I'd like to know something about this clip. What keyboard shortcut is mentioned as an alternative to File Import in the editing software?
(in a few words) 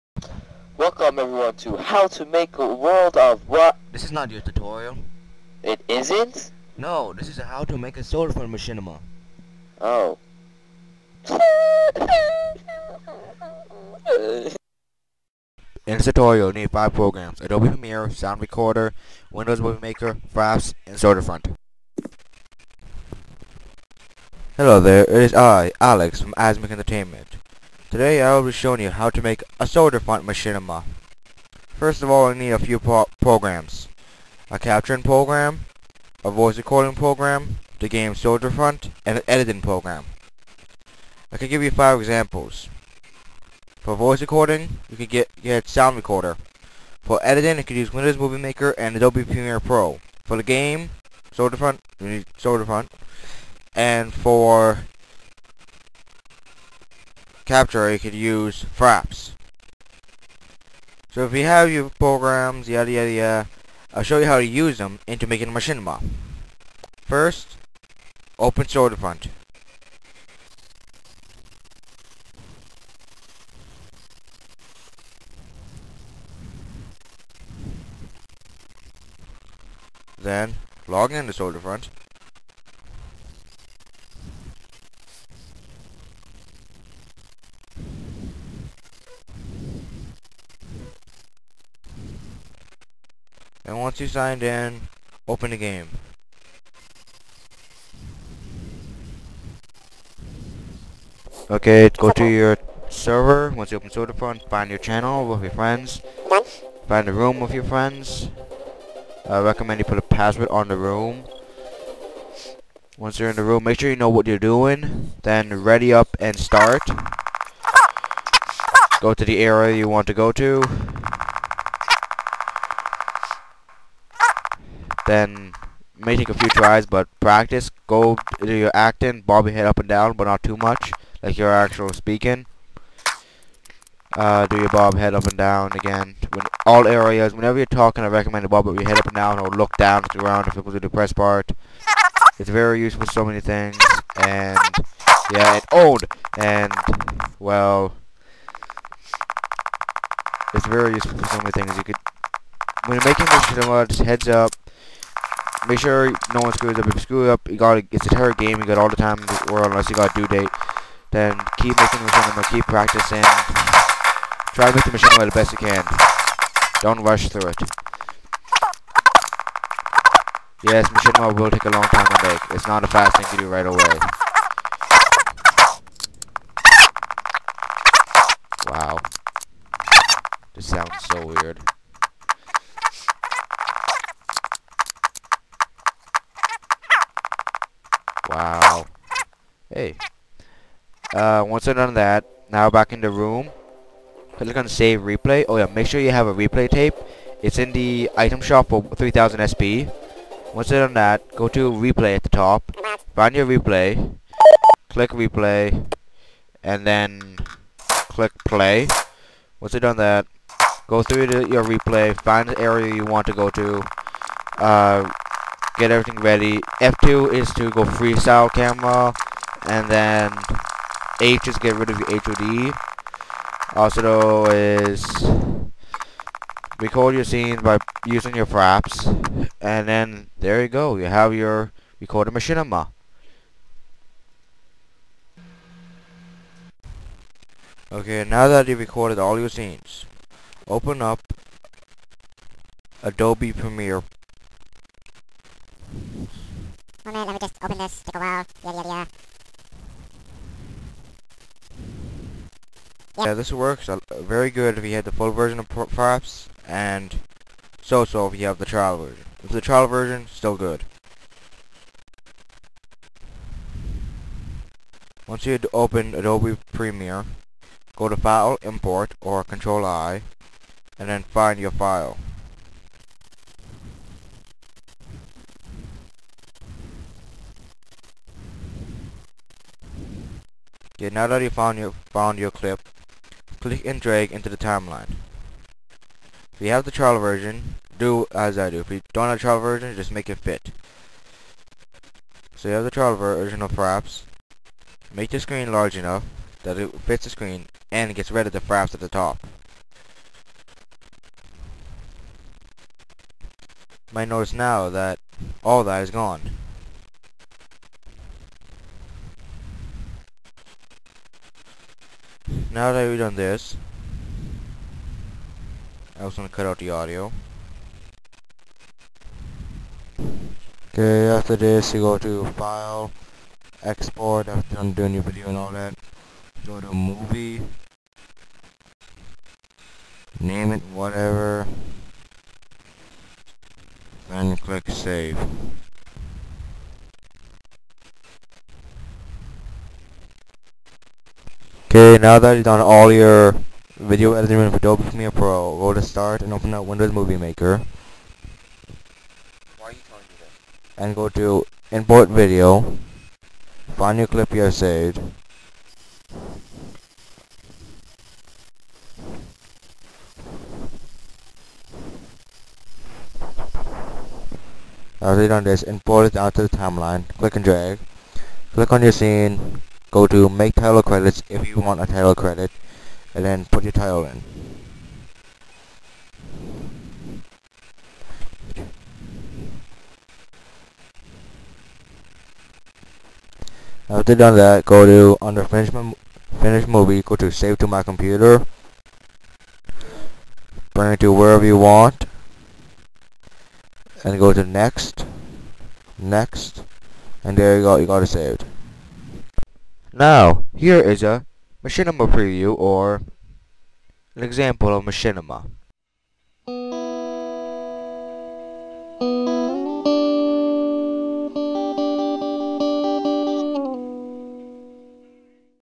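Control I.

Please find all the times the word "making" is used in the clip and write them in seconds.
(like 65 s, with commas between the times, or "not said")
65 s, 153 s, 161 s.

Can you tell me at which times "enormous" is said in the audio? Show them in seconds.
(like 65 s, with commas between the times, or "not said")
not said.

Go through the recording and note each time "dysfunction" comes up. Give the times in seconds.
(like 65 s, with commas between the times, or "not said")
not said.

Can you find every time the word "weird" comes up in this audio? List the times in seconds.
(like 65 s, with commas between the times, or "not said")
181 s.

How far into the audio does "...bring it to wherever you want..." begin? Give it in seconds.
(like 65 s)
390 s.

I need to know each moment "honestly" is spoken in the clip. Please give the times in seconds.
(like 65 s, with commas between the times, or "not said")
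not said.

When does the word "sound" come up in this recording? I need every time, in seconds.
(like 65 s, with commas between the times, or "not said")
18 s, 45 s, 180 s.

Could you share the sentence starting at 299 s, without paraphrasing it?
You might notice now that all that is gone.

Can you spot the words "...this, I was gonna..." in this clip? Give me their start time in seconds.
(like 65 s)
313 s.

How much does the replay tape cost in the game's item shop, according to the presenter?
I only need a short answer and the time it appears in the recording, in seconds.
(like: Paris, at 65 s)
3000 SP, at 198 s.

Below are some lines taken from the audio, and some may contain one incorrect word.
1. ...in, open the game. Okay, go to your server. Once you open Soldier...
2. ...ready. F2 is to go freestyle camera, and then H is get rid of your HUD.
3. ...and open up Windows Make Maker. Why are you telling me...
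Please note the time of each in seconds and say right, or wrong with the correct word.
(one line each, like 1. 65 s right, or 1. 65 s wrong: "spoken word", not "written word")
1. 94 s right
2. 216 s right
3. 346 s wrong: "Movie", not "Make".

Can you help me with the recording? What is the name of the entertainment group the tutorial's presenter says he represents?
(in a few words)
AsMake Entertainment.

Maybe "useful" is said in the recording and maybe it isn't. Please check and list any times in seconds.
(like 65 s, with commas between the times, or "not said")
142 s, 150 s.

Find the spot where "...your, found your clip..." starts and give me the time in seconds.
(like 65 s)
281 s.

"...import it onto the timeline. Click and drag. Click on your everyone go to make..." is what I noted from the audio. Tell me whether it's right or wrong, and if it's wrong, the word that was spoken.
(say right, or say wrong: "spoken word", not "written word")
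wrong: "scene", not "everyone".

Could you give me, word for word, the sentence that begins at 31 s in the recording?
First of all I need a few pro programs.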